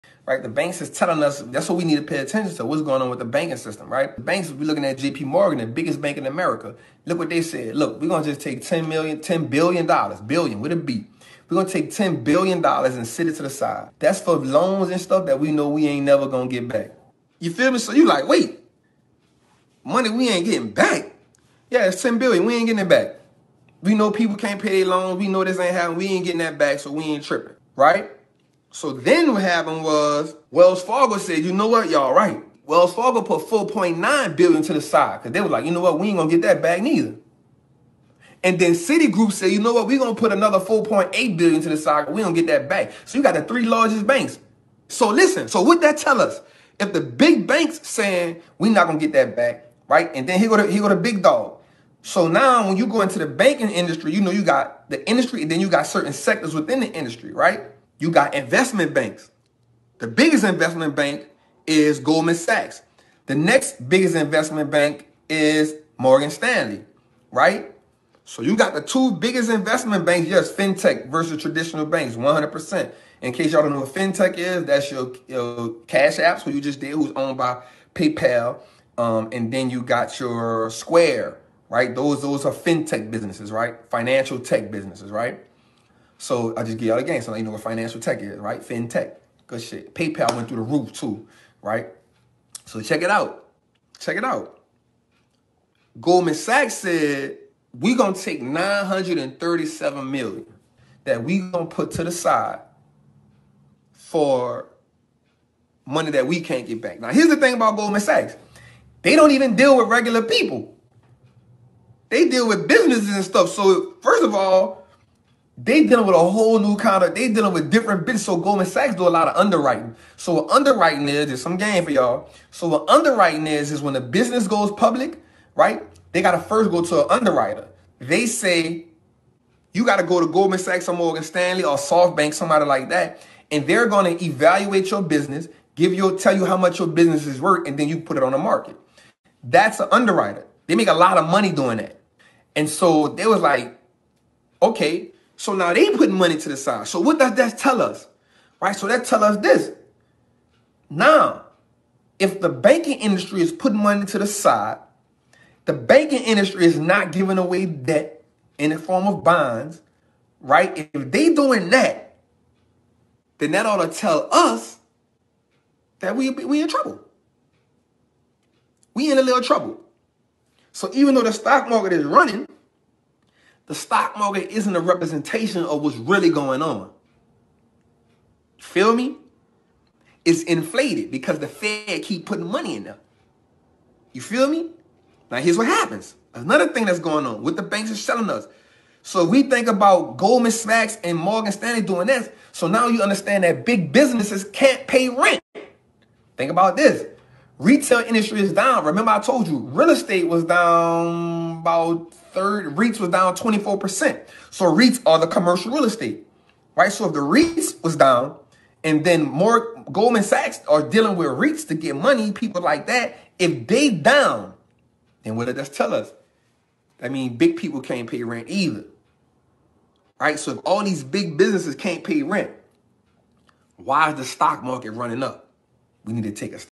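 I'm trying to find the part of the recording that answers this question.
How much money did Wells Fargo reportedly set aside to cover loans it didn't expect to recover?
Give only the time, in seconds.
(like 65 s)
33 s.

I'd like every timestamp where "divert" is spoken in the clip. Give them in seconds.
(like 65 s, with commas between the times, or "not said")
not said.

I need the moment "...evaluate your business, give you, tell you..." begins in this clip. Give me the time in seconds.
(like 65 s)
134 s.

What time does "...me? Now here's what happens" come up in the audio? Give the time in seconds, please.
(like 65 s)
184 s.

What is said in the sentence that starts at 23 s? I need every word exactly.
We know people can't pay their loans.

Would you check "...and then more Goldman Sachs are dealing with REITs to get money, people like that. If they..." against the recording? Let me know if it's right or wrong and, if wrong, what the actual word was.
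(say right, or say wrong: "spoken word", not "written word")
right.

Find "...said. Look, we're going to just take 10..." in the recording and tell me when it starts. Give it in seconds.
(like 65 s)
7 s.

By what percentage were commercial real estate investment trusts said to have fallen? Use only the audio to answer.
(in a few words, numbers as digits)
24%.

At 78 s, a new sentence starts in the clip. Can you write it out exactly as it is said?
Um, and then you got your Square, right?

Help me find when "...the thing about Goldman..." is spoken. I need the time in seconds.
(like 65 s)
107 s.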